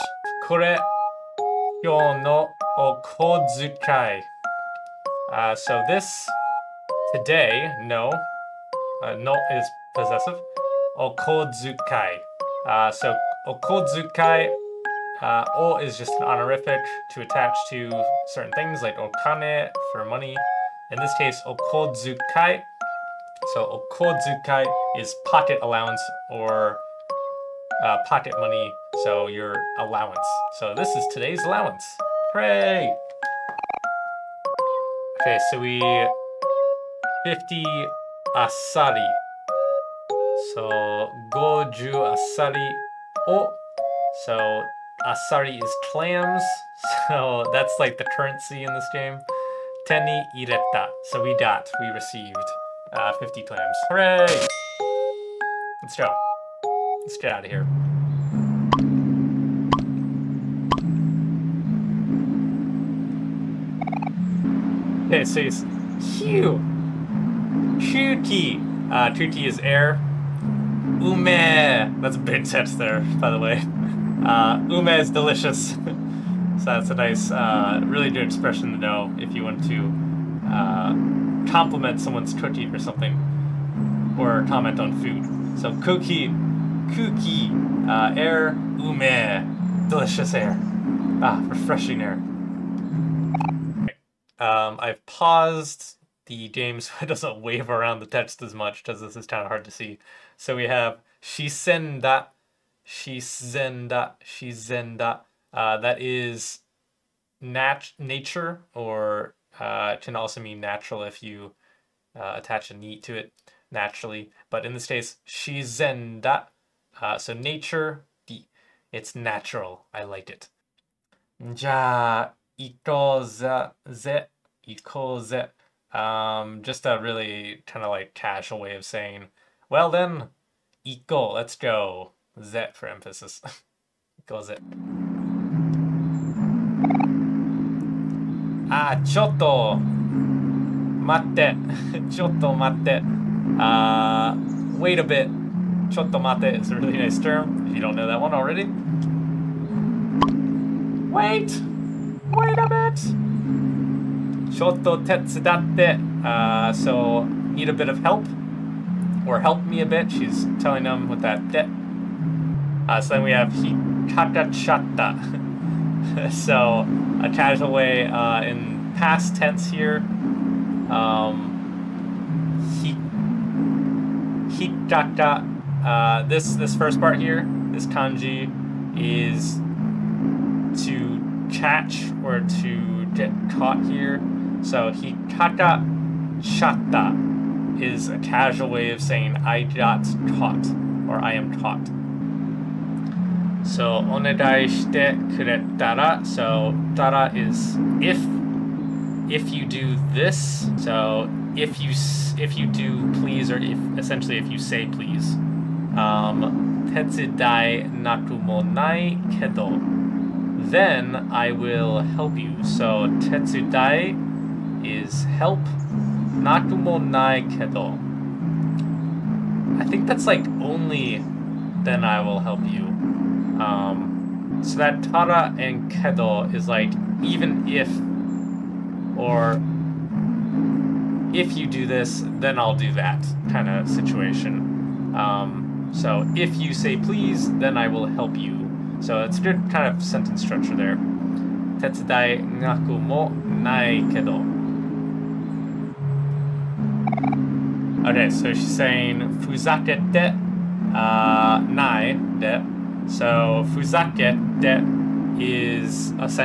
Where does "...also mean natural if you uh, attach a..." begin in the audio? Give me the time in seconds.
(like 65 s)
110 s.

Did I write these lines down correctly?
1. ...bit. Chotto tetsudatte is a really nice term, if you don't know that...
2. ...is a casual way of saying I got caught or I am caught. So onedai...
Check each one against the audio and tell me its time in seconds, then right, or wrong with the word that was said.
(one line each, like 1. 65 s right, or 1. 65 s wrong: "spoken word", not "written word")
1. 145 s wrong: "matte", not "tetsudatte"
2. 187 s right.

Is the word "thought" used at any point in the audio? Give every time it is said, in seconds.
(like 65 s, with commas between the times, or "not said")
not said.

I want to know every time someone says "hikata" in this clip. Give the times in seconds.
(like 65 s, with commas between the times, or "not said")
163 s, 174 s, 184 s.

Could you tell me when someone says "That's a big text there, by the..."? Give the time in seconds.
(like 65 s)
72 s.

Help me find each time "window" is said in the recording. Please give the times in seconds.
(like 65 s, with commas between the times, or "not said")
not said.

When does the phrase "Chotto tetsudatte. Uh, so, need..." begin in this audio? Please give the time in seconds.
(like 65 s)
154 s.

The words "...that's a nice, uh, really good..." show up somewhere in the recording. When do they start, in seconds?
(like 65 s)
76 s.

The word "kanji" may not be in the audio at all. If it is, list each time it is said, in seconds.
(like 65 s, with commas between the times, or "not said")
177 s.